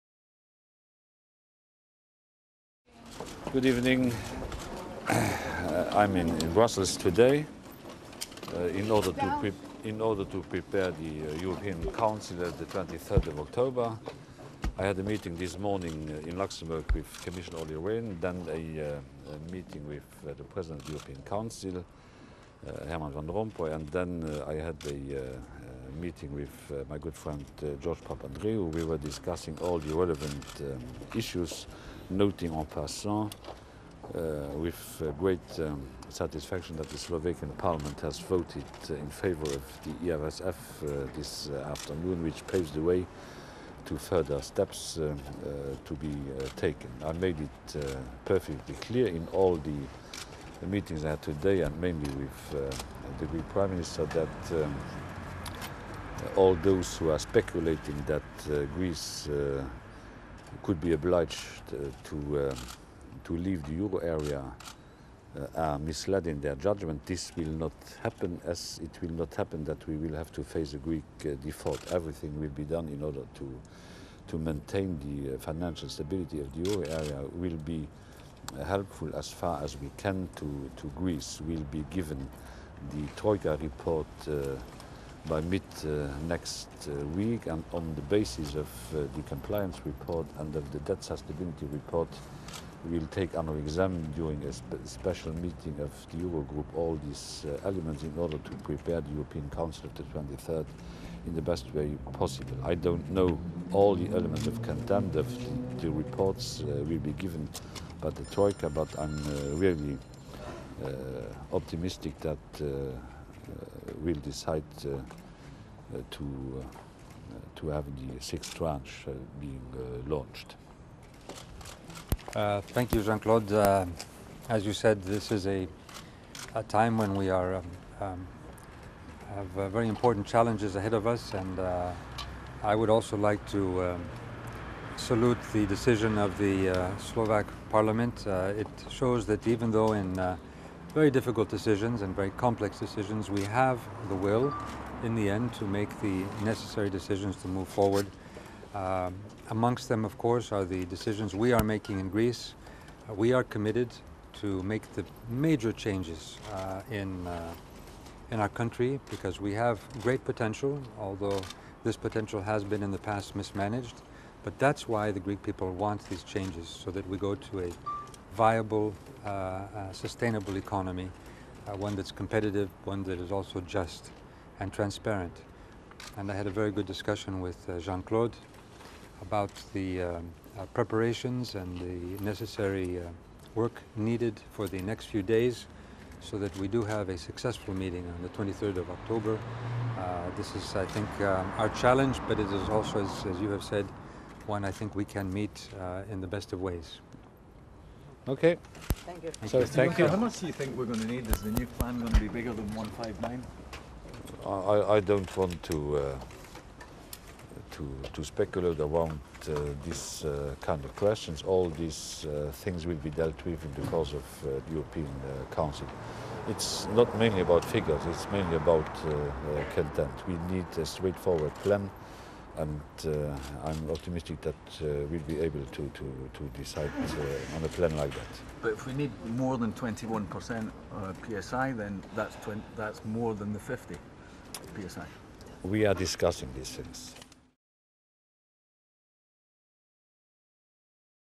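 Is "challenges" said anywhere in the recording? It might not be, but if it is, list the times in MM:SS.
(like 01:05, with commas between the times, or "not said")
02:10, 03:11.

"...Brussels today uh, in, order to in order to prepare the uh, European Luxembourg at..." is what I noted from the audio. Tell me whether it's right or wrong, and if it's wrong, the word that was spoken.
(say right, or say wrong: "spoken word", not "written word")
wrong: "Council", not "Luxembourg".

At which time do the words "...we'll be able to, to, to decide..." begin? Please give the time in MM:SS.
03:45.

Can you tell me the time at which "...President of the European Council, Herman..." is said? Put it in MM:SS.
00:20.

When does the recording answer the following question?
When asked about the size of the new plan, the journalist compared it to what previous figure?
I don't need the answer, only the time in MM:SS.
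03:22.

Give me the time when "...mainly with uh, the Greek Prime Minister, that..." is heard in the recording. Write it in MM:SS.
00:51.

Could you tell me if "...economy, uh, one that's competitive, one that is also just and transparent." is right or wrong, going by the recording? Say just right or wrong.
right.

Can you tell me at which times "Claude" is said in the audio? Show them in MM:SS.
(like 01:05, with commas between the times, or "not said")
02:03, 02:57.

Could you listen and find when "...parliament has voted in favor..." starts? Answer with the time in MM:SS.
00:37.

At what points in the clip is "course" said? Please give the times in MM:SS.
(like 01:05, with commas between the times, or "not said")
02:30, 03:33.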